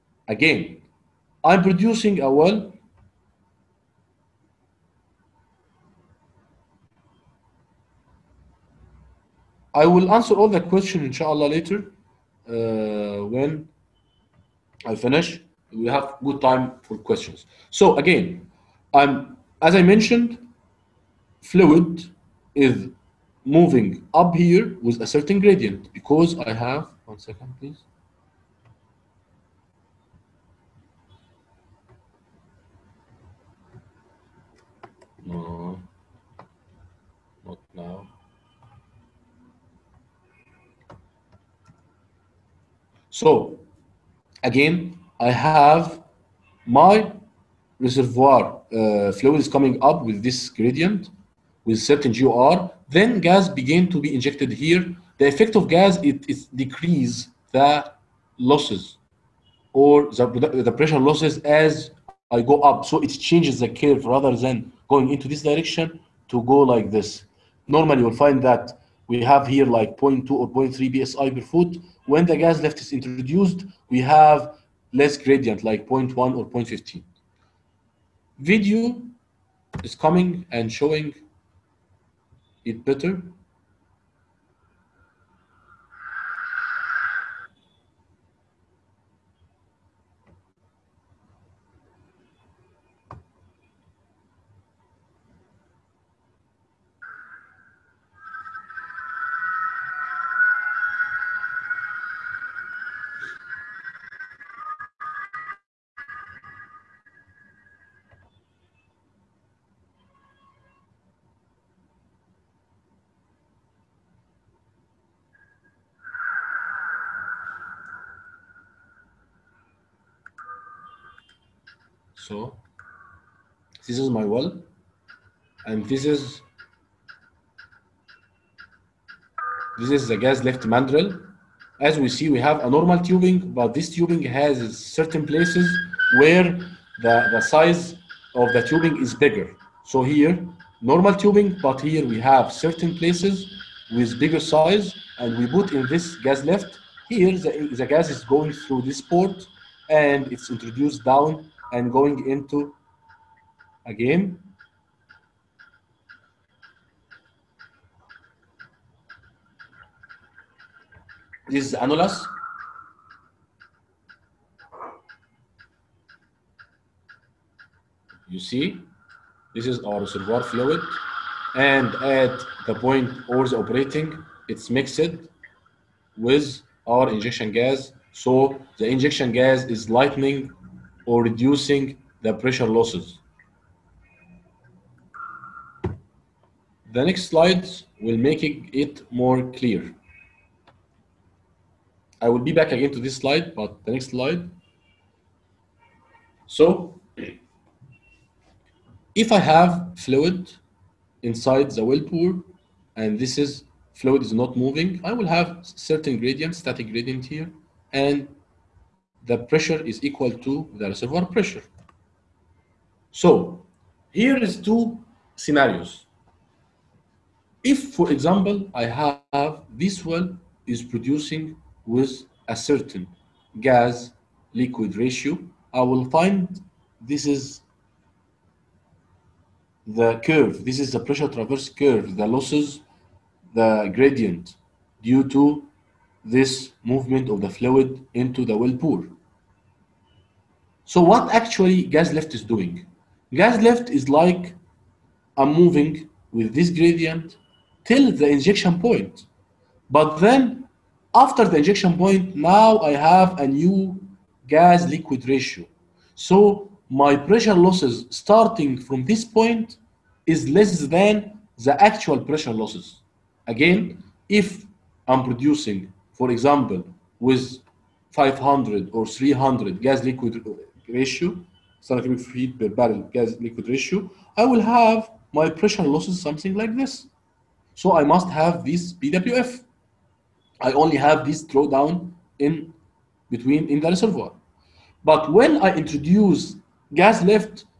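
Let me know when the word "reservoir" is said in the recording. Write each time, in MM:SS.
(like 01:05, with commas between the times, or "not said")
00:47, 02:50, 03:30, 04:43.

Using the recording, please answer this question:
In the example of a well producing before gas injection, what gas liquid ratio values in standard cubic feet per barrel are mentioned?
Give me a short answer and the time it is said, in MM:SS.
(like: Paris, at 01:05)
500 or 300, at 04:28.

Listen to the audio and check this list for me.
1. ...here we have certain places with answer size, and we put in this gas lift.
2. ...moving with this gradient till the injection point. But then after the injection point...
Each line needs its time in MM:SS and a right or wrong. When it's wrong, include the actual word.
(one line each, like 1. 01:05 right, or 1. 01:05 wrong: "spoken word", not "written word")
1. 02:21 wrong: "bigger", not "answer"
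2. 04:05 right.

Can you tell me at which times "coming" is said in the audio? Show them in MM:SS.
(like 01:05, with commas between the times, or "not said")
00:49, 01:19.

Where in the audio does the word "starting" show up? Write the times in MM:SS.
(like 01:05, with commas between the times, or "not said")
04:18.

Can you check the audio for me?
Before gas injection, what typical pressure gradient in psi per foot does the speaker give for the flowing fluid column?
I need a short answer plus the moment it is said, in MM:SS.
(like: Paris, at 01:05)
0.2 or 0.3, at 01:09.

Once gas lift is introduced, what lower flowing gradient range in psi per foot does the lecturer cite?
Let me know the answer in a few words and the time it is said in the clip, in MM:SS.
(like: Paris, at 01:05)
0.1 or 0.15, at 01:15.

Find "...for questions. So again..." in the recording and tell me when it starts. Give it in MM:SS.
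00:16.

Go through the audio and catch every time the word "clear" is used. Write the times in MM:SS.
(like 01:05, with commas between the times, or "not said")
03:09.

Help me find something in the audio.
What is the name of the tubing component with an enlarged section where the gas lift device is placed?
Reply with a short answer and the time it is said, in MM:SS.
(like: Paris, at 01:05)
gas lift mandrel, at 02:10.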